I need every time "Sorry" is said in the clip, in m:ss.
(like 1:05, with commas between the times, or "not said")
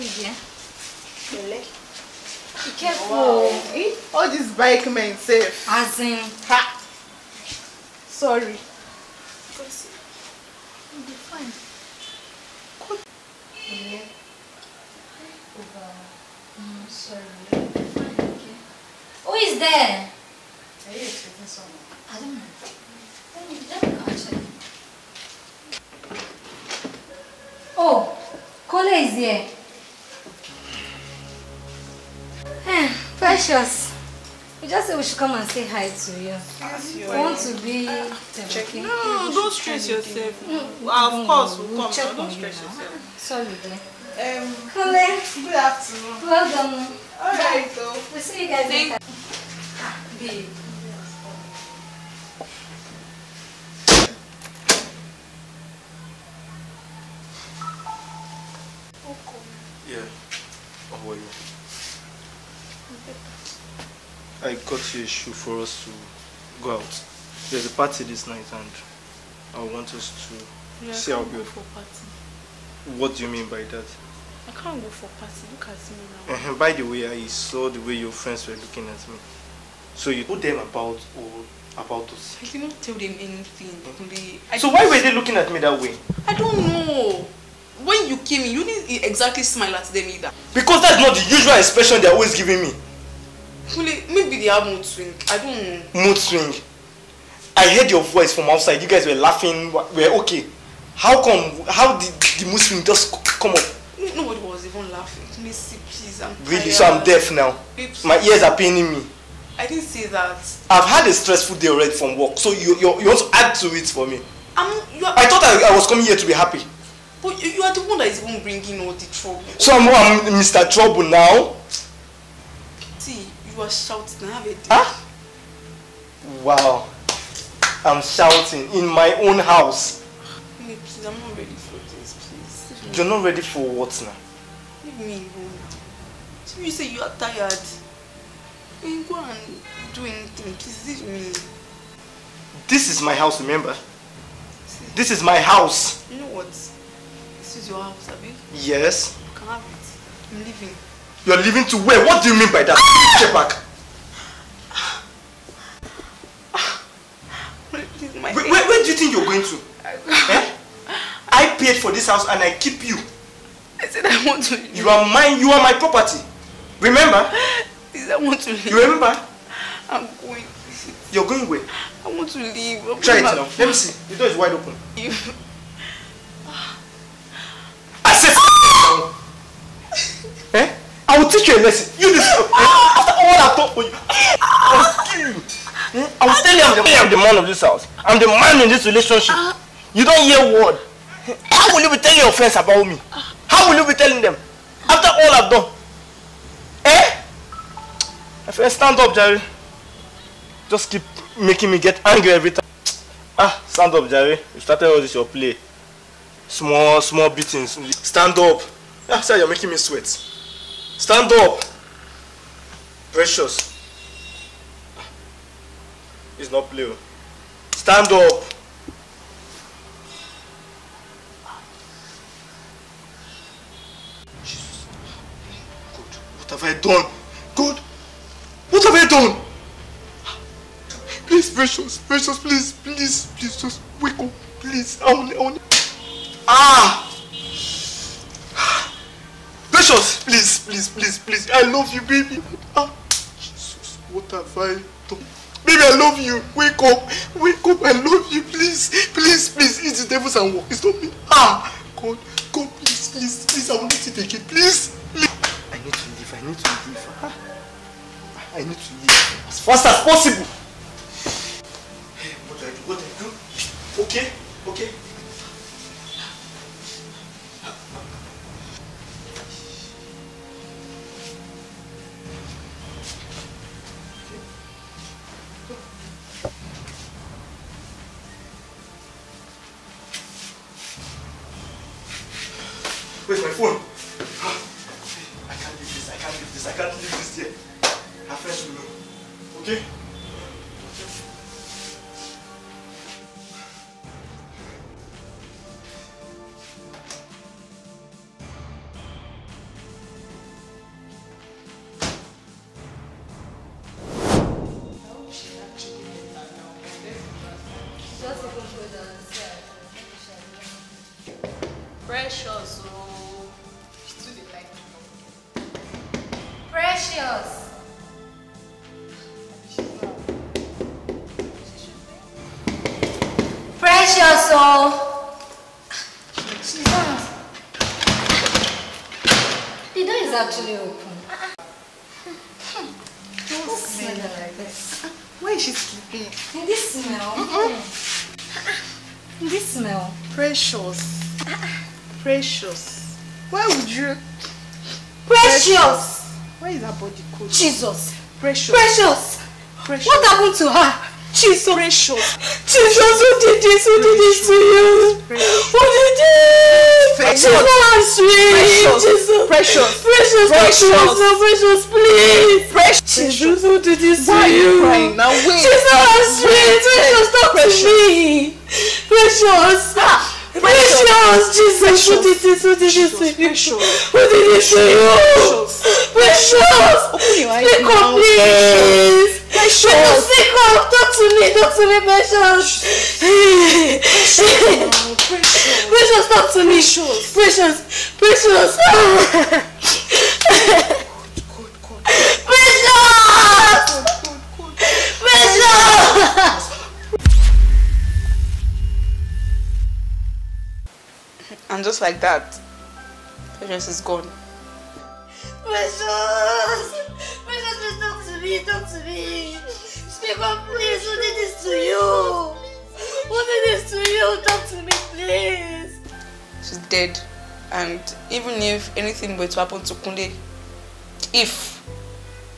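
0:08, 0:43.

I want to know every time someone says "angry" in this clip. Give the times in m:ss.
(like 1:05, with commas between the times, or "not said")
3:22.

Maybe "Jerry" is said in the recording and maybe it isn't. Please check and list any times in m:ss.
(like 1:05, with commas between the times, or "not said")
3:19, 3:24.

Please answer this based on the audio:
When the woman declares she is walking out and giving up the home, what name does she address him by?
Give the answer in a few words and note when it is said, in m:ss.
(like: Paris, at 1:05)
Abby, at 2:28.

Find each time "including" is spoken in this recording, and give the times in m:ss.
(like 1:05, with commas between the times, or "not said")
not said.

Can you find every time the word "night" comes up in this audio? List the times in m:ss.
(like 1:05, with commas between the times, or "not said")
1:08.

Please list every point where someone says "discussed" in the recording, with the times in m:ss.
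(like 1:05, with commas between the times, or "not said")
not said.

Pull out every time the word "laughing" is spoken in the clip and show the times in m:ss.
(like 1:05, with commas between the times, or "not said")
1:39, 1:44.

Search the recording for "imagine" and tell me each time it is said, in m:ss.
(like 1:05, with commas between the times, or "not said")
not said.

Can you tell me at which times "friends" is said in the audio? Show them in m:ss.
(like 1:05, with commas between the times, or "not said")
1:18, 3:12, 3:18, 4:48.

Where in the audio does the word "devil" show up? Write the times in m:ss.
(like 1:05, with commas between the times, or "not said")
4:10.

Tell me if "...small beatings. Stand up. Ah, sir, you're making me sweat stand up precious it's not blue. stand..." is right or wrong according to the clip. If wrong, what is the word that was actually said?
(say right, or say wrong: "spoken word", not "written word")
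right.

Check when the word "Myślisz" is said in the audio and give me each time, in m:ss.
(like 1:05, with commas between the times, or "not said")
6:25.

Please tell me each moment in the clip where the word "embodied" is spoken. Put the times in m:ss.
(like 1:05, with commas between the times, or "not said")
not said.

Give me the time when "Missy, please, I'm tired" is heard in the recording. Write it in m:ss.
1:45.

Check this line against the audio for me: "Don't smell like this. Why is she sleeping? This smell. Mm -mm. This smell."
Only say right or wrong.
right.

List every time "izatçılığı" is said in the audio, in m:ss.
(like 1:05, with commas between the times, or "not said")
5:30.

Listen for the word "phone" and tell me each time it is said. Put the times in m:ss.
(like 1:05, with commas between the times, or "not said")
4:43.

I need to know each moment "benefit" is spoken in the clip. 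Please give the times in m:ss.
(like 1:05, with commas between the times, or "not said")
not said.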